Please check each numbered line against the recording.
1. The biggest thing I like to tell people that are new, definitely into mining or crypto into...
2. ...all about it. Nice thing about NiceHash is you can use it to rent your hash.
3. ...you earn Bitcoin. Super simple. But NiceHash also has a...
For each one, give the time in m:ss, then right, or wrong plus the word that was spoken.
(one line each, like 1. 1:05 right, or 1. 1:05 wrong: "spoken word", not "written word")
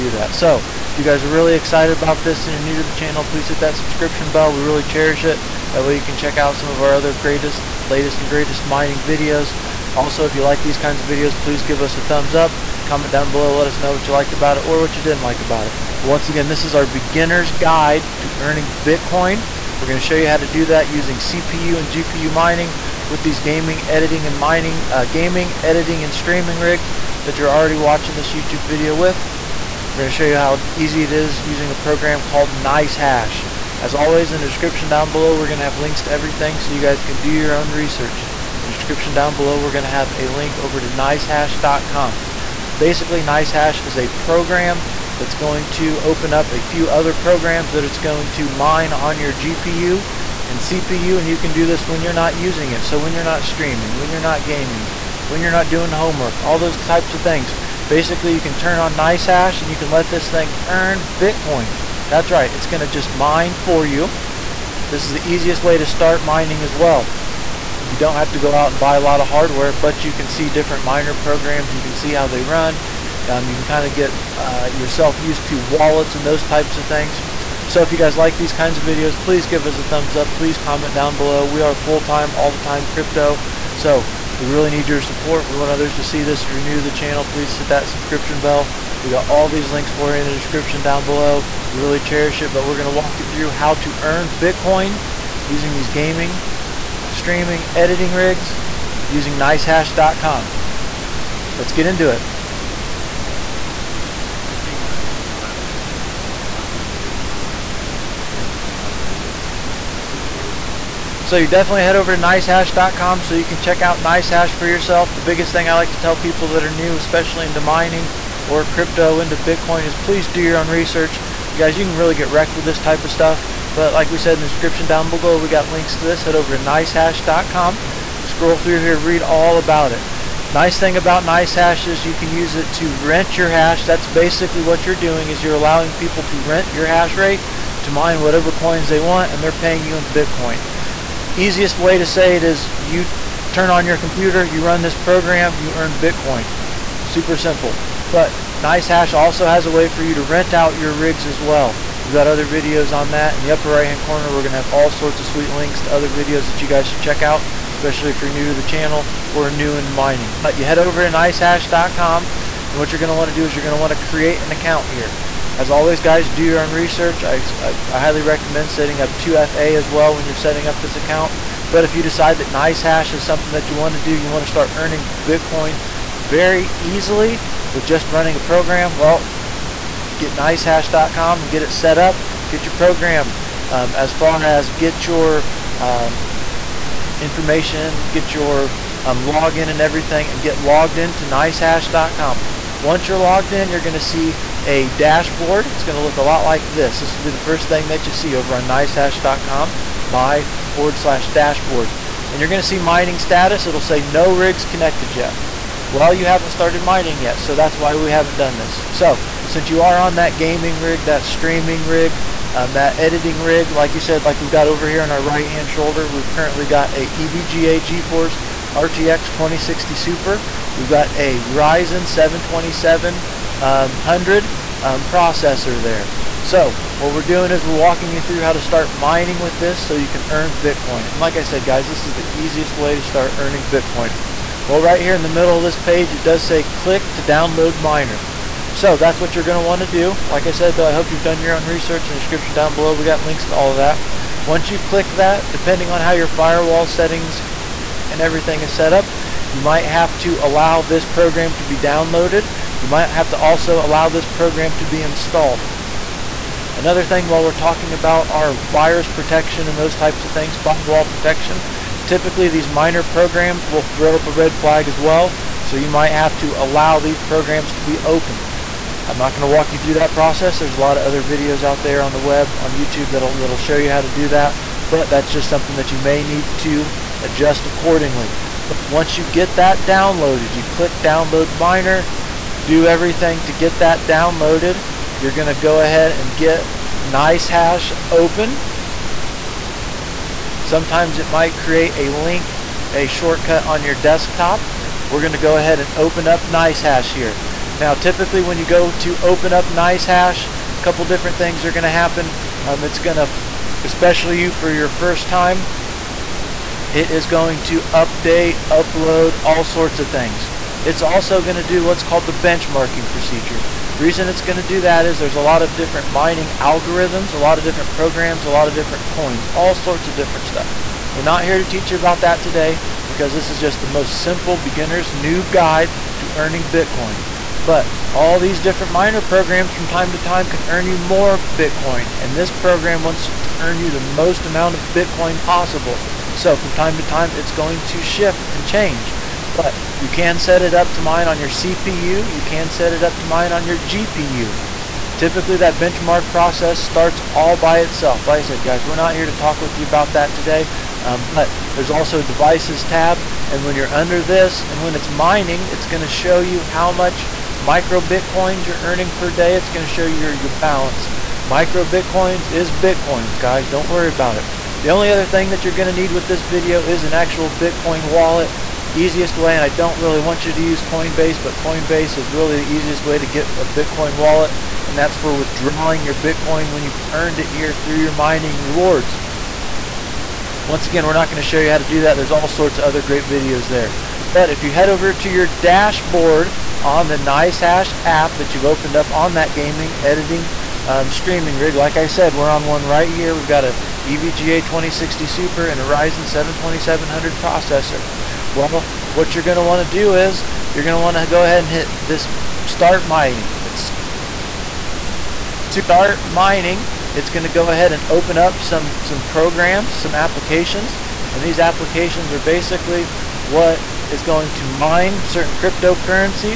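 1. 1:55 wrong: "especially", not "definitely"
2. 2:09 right
3. 2:25 right.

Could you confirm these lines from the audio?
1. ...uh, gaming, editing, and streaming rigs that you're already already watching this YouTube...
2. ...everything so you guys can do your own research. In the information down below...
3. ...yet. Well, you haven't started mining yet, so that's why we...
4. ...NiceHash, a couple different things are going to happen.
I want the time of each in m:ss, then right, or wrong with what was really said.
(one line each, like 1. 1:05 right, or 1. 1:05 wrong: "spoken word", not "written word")
1. 0:24 right
2. 0:36 wrong: "description", not "information"
3. 3:25 right
4. 4:59 right.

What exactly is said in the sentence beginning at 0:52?
So when you're not streaming, when you're not gaming, when you're not doing homework, all those types of things.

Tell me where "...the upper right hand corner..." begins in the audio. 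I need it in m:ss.
2:33.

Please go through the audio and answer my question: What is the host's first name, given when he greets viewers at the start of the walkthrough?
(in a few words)
Wes.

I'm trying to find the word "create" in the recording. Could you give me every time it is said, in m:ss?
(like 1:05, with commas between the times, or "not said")
2:43, 4:51.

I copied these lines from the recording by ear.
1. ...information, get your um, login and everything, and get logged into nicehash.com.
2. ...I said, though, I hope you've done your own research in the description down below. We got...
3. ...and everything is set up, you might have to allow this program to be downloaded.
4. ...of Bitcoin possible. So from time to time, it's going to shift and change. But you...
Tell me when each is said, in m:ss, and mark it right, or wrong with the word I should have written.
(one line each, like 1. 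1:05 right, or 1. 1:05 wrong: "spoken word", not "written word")
1. 3:07 right
2. 4:00 right
3. 4:08 right
4. 5:34 right.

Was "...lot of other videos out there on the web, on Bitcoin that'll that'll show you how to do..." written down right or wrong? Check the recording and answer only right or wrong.
wrong.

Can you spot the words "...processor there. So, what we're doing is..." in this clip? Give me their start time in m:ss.
3:45.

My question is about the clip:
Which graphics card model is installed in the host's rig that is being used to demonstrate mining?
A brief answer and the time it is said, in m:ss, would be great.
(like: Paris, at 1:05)
EVGA GeForce RTX 2060 Super, at 3:37.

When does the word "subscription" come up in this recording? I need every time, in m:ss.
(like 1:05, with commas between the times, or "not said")
0:03, 1:27.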